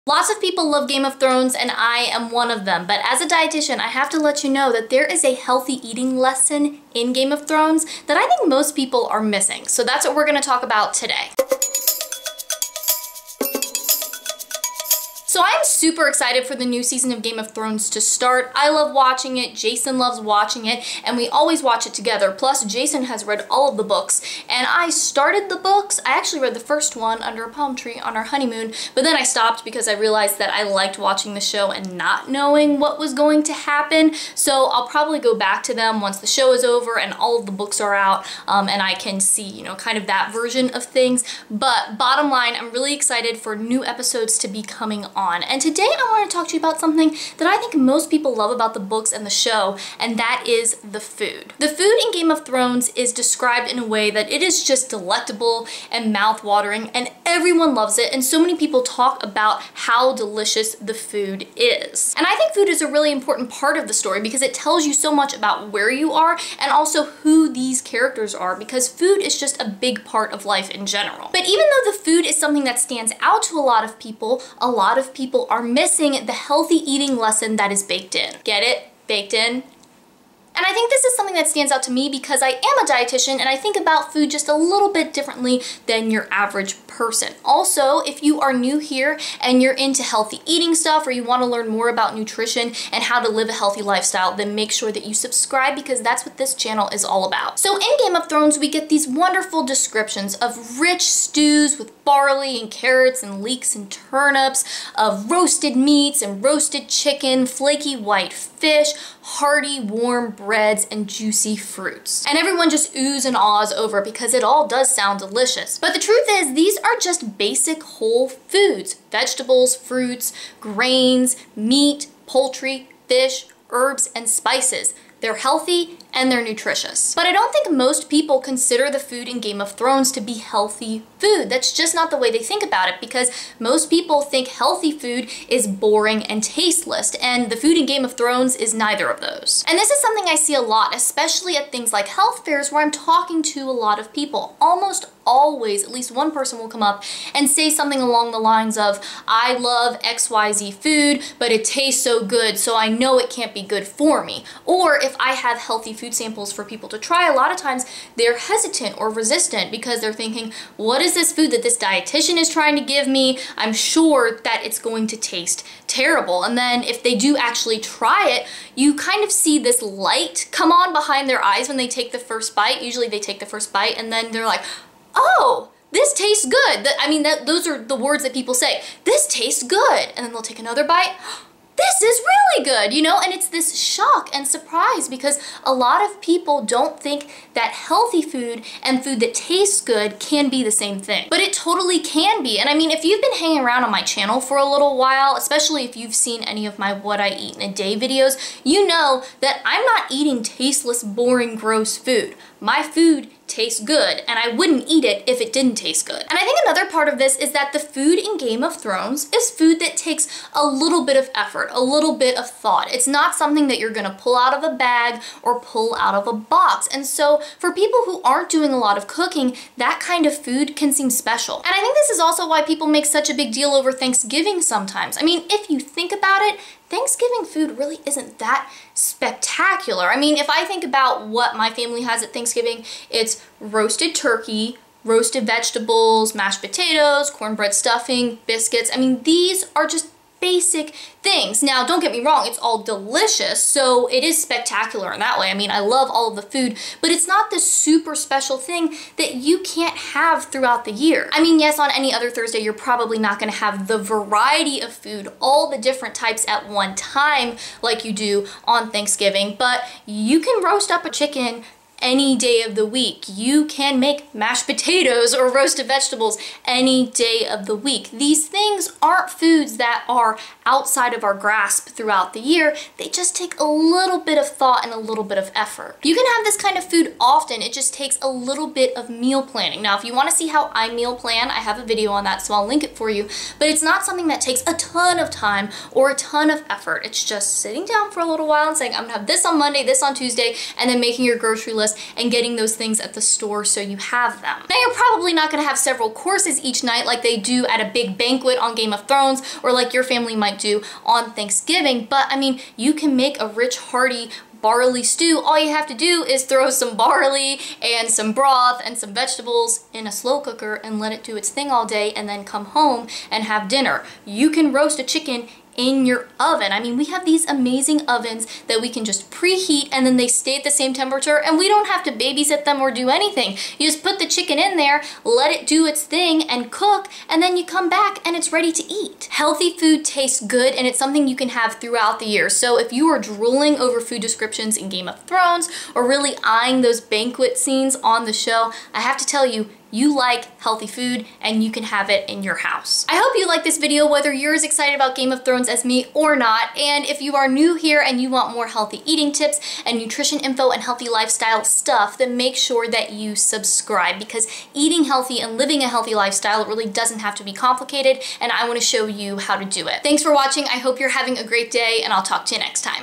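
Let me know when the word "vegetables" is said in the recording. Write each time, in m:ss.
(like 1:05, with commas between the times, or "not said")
1:59, 3:55, 4:25, 5:09.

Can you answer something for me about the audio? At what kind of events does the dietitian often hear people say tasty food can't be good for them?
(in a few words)
Health fairs.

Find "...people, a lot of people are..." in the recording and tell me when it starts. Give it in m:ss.
1:13.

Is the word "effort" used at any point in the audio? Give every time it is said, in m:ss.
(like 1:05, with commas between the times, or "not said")
3:31, 4:35, 4:46.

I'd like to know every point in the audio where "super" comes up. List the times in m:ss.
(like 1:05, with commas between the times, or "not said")
0:15, 4:07.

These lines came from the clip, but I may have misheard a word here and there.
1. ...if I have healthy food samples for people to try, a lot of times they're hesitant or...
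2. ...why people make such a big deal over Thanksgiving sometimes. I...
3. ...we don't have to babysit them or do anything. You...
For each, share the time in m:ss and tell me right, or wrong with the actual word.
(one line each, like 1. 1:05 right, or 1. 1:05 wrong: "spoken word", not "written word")
1. 2:34 right
2. 3:42 right
3. 5:21 right.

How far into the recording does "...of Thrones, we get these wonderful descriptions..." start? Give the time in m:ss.
1:38.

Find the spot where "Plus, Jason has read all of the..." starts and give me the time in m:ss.
0:22.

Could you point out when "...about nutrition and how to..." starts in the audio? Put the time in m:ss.
1:31.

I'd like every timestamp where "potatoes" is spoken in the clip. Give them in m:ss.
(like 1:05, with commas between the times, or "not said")
3:56, 4:24.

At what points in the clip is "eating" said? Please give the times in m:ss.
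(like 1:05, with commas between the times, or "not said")
0:05, 1:16, 1:30, 3:20, 5:49, 5:54.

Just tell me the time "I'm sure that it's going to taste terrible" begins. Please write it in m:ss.
2:43.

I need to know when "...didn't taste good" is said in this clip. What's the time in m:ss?
3:25.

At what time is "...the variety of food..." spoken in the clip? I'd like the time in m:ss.
4:13.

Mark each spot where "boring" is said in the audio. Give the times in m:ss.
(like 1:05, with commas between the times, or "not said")
2:15, 3:21.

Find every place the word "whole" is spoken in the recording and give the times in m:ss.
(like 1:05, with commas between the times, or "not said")
1:57.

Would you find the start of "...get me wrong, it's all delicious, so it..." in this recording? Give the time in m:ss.
4:02.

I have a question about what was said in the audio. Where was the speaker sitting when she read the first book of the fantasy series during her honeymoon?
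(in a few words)
Under a palm tree.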